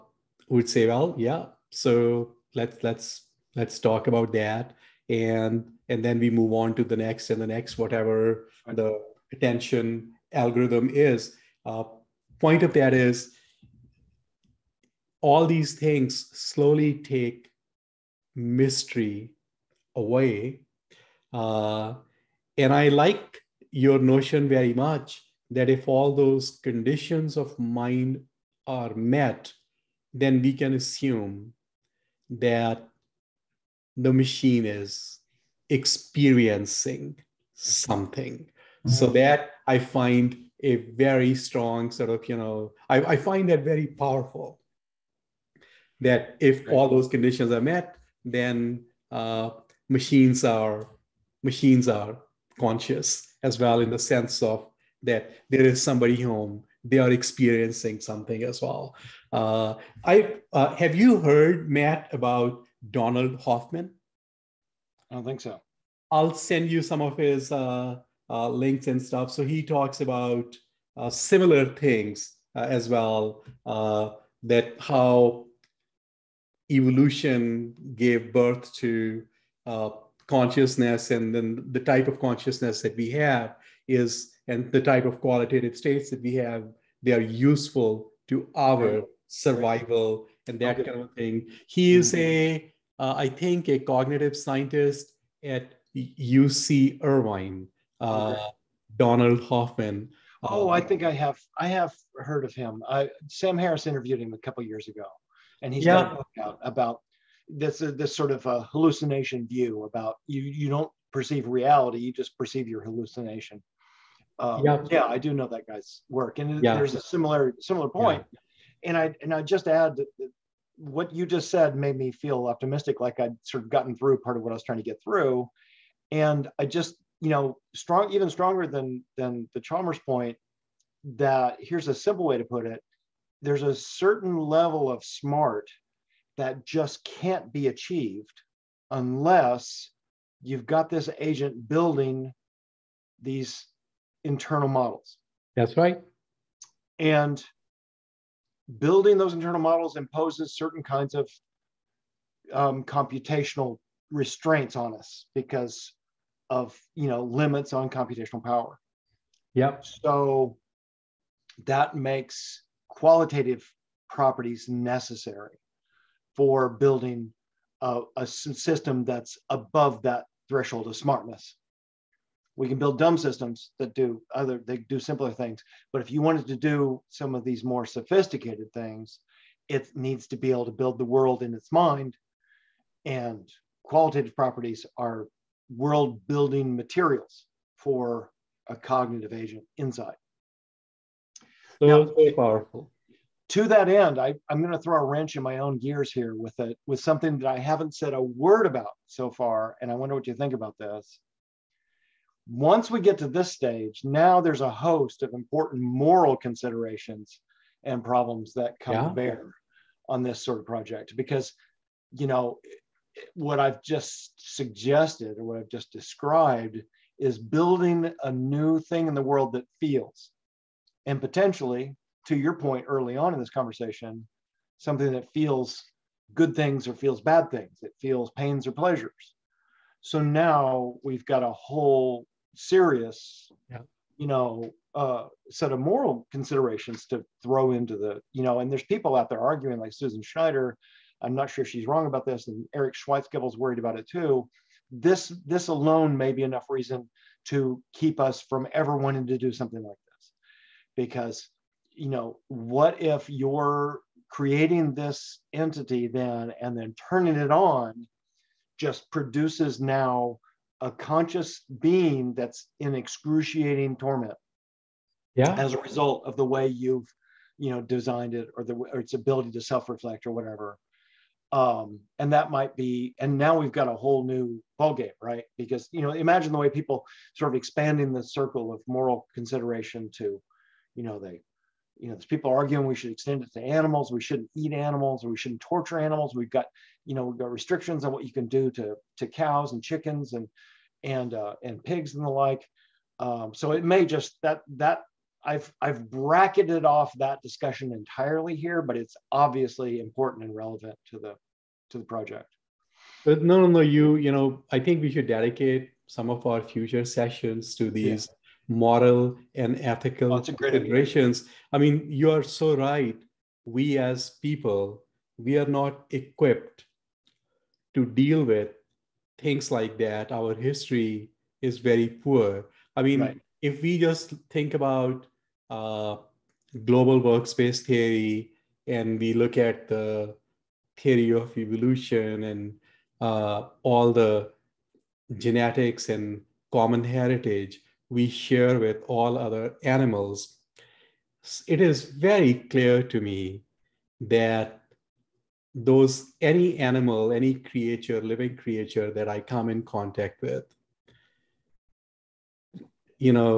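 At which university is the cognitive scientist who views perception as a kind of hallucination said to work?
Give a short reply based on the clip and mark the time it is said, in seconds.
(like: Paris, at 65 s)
UC Irvine, at 95 s.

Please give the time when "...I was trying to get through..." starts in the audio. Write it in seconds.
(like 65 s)
124 s.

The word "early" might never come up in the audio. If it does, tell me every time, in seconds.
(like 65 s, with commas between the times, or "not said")
222 s.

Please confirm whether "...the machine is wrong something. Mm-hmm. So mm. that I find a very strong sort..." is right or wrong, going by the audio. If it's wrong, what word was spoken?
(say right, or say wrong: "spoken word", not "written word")
wrong: "experiencing", not "wrong".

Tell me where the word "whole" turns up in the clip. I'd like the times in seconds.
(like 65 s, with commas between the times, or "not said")
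231 s, 273 s.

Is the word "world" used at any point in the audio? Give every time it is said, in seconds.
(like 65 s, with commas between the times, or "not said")
181 s, 185 s, 219 s.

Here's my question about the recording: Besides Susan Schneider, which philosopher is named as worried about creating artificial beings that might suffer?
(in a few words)
Eric Schwitzgebel.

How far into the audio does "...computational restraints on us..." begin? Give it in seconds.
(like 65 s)
152 s.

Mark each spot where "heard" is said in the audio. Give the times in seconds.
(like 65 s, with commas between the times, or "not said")
61 s, 102 s.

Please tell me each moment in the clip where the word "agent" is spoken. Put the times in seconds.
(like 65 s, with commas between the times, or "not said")
141 s, 189 s.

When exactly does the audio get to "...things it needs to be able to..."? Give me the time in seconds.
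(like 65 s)
178 s.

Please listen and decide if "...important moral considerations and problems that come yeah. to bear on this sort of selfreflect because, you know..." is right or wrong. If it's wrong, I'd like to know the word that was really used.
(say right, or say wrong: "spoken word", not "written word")
wrong: "project", not "selfreflect".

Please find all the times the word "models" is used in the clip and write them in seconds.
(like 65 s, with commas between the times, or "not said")
144 s, 149 s.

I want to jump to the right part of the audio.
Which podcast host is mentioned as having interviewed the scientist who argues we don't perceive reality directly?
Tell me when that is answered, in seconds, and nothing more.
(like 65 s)
103 s.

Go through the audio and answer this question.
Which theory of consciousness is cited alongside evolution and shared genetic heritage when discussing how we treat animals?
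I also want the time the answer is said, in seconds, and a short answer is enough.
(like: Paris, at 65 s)
Global workspace theory, at 326 s.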